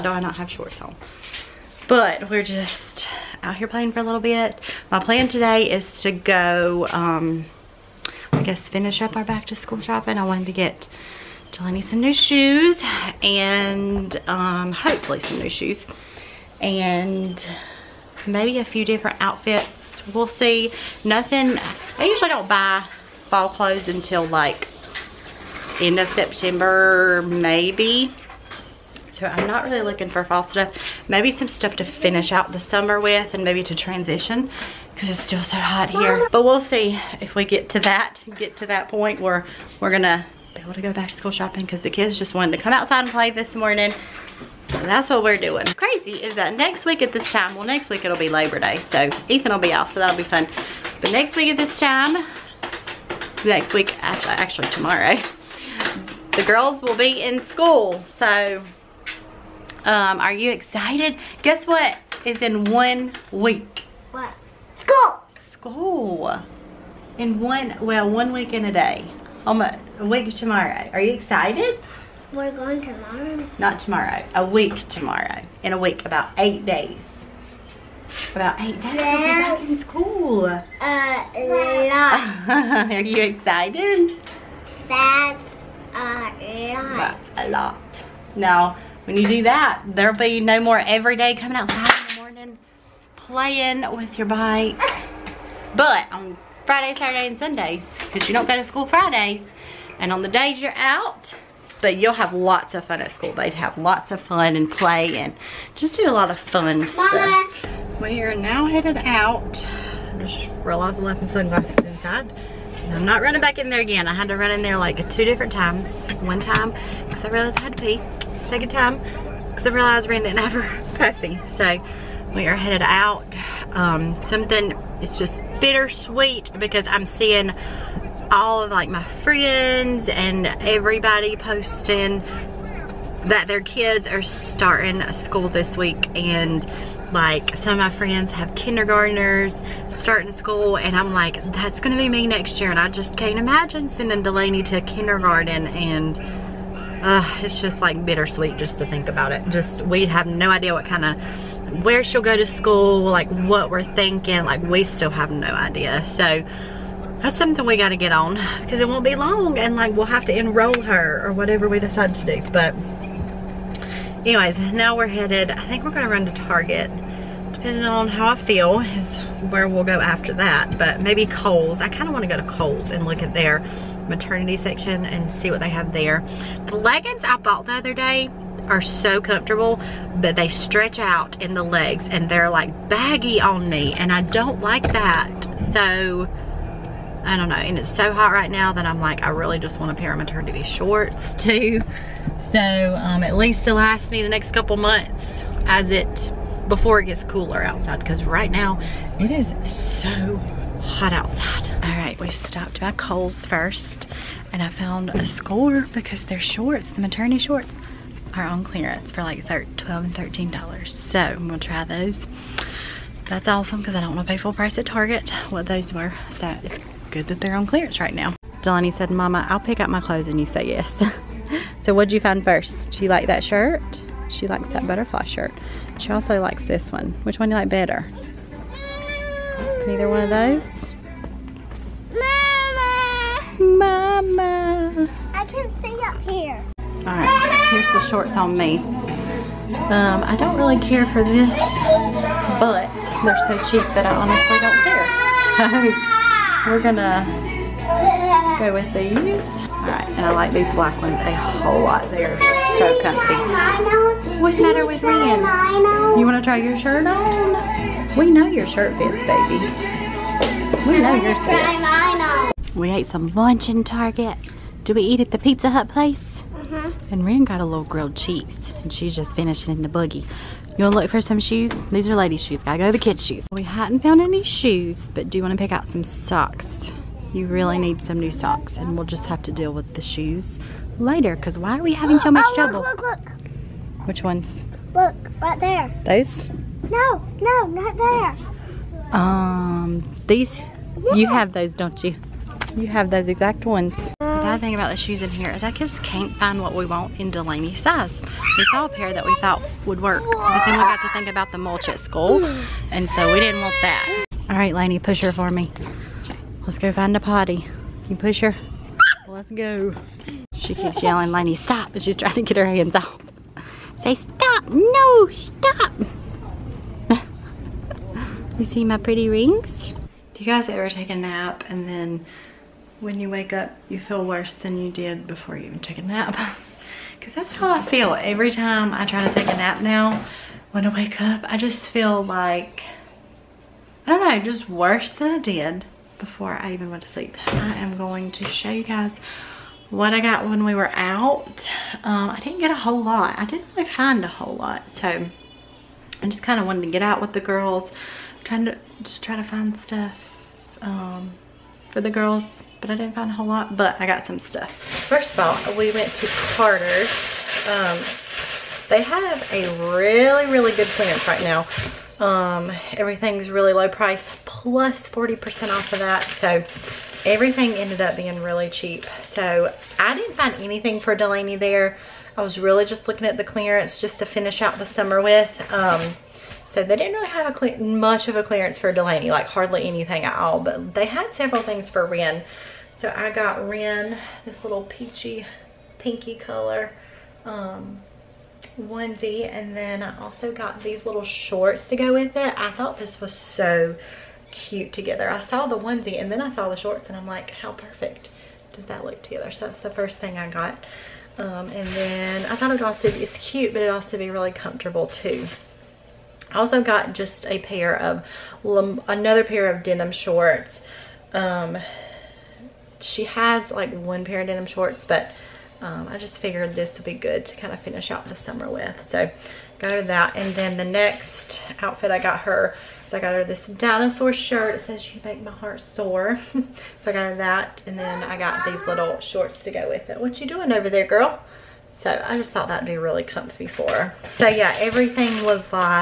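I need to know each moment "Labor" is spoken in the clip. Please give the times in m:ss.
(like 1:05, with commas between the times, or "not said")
0:48.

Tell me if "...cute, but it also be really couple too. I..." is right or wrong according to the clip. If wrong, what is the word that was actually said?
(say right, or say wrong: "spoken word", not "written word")
wrong: "comfortable", not "couple".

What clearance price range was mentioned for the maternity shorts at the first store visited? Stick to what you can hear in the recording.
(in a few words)
12 and $13.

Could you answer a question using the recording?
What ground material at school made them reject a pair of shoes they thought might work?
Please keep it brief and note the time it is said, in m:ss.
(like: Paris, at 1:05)
Mulch, at 5:01.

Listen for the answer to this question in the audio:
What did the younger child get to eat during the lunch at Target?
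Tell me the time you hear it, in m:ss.
4:27.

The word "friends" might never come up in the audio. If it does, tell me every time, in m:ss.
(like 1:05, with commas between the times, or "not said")
2:09, 2:17.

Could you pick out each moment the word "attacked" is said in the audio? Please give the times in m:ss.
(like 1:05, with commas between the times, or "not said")
not said.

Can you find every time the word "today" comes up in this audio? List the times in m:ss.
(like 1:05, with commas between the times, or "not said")
0:05.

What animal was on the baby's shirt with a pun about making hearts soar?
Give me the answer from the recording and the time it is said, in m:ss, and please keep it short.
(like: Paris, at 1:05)
Dinosaur, at 7:03.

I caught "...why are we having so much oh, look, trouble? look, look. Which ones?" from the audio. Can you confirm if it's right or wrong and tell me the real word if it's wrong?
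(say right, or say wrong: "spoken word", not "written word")
right.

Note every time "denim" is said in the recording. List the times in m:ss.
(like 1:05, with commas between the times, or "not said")
6:49, 6:54.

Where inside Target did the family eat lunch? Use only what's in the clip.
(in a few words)
Pizza Hut.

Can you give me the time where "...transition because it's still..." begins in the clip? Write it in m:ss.
0:33.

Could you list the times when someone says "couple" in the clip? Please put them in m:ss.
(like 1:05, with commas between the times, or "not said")
3:14.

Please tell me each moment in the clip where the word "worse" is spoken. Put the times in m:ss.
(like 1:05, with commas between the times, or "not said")
5:24, 5:34.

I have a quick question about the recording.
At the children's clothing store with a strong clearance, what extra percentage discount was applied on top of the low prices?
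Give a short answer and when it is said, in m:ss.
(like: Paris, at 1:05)
40%, at 6:05.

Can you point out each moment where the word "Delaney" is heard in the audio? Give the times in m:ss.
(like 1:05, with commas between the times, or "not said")
0:11, 2:24, 3:38, 4:57, 6:11, 6:18.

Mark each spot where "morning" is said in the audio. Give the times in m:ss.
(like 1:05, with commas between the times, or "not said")
0:43, 1:32.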